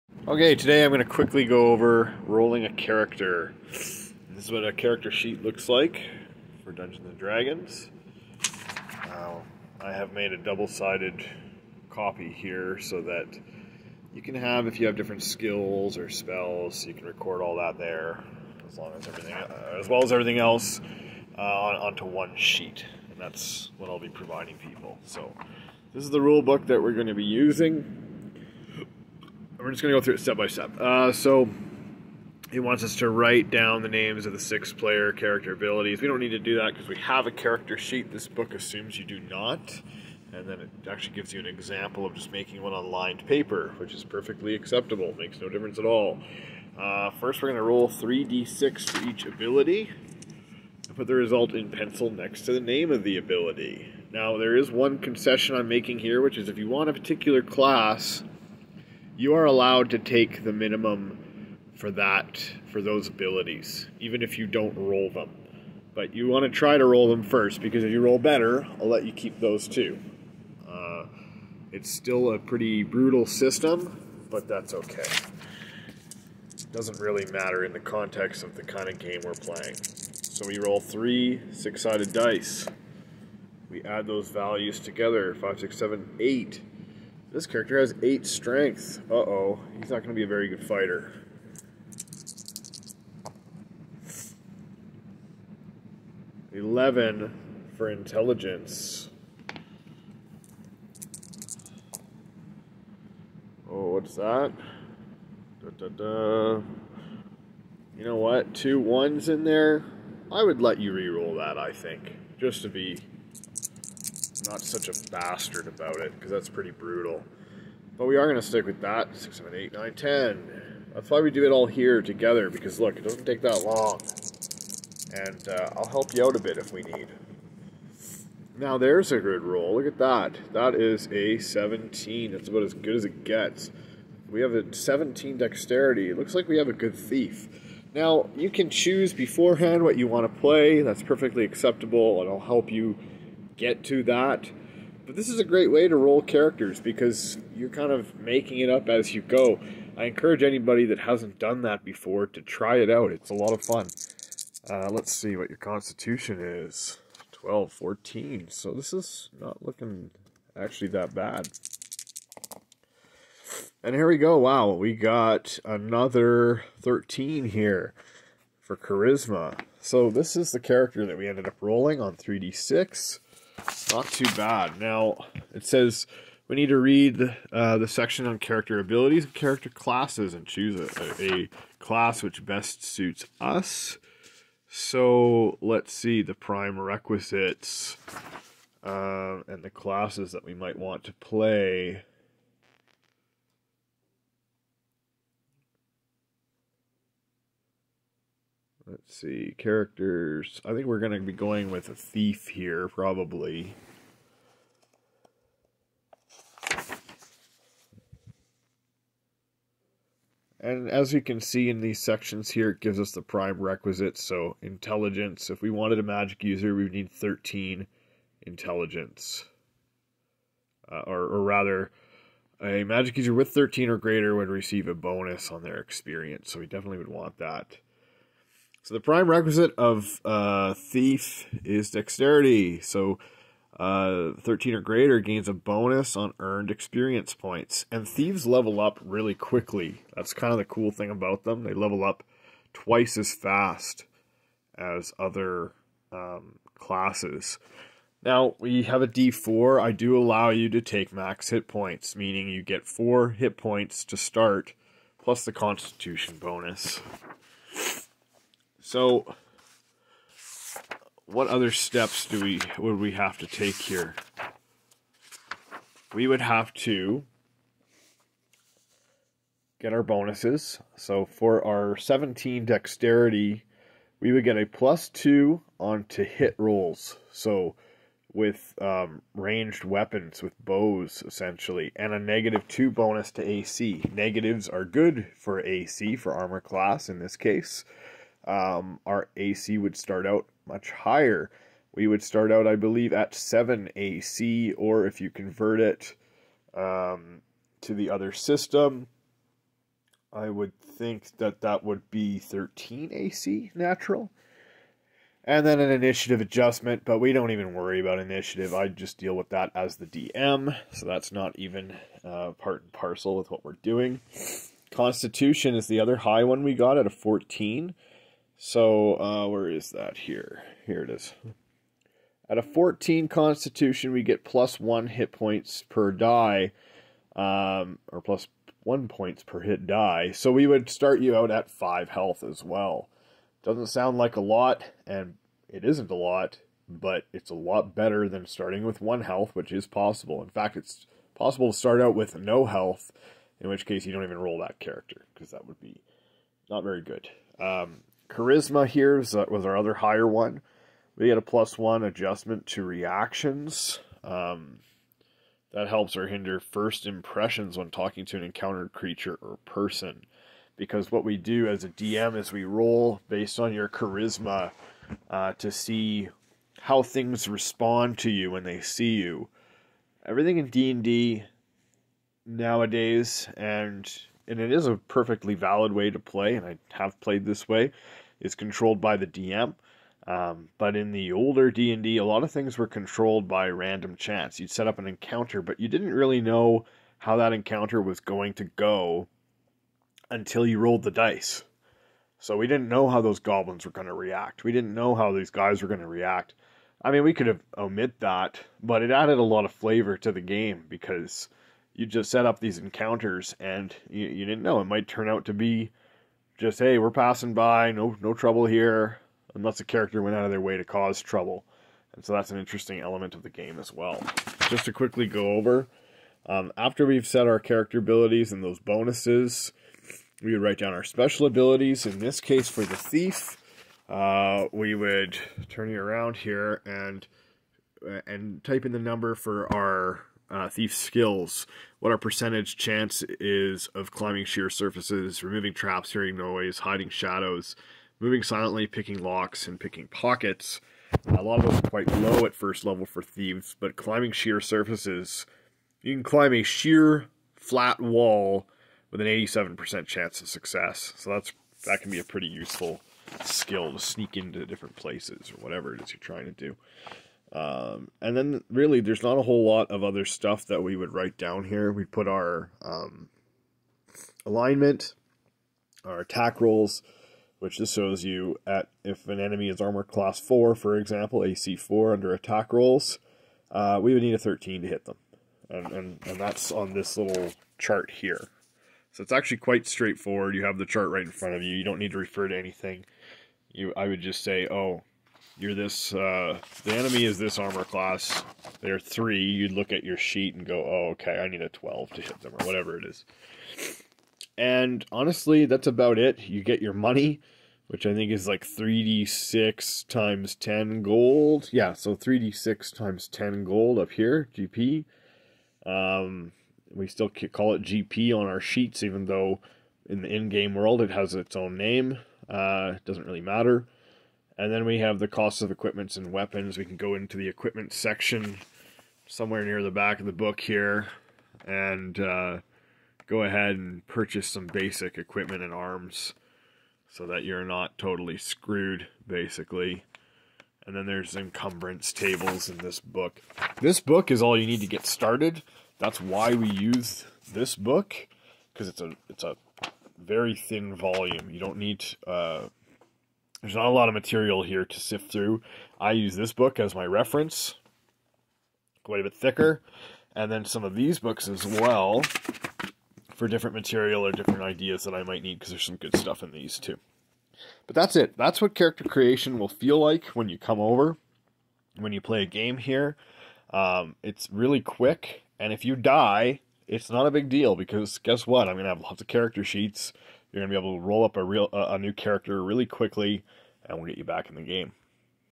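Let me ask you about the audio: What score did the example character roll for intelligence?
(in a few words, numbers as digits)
11.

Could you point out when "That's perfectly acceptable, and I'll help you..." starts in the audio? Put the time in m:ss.
2:20.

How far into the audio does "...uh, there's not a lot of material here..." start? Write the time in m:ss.
9:02.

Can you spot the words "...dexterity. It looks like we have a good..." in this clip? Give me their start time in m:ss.
2:15.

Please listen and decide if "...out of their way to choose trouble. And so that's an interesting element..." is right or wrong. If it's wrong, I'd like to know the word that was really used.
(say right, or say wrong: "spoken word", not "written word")
wrong: "cause", not "choose".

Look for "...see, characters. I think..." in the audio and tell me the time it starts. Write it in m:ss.
3:19.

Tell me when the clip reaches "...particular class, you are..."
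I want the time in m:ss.
0:56.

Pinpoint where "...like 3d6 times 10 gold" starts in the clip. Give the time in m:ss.
8:18.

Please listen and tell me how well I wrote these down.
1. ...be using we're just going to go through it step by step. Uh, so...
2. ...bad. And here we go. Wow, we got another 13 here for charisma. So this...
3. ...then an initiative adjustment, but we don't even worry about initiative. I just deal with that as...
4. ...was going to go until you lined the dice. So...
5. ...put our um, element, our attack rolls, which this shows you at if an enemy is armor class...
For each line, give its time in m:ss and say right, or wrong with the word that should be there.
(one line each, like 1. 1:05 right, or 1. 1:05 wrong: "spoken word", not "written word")
1. 0:27 right
2. 2:41 right
3. 5:05 right
4. 6:28 wrong: "rolled", not "lined"
5. 7:42 wrong: "alignment", not "element".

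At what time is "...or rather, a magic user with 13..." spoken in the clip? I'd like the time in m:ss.
3:41.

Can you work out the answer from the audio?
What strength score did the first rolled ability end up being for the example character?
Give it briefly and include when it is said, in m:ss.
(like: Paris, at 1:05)
8, at 1:28.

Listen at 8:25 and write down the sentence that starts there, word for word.
Um, we still call it GP on our sheets, even though in the in-game world it has its own name.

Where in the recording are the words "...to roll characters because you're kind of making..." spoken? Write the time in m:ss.
2:25.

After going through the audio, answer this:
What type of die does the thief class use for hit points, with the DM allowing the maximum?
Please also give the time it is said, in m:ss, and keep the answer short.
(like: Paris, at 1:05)
d4, at 4:09.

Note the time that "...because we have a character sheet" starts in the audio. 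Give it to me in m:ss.
0:36.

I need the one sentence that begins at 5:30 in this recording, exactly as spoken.
So we would start you out at five health as well.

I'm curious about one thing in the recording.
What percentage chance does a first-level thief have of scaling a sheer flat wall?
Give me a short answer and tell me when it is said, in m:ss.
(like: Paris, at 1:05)
87%, at 7:29.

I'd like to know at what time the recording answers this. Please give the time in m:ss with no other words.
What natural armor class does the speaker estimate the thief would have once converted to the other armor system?
5:02.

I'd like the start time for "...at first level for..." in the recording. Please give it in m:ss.
7:22.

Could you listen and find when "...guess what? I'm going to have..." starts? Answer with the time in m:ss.
9:28.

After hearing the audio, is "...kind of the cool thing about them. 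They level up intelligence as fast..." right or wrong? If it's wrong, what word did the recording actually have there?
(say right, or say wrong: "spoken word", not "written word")
wrong: "twice", not "intelligence".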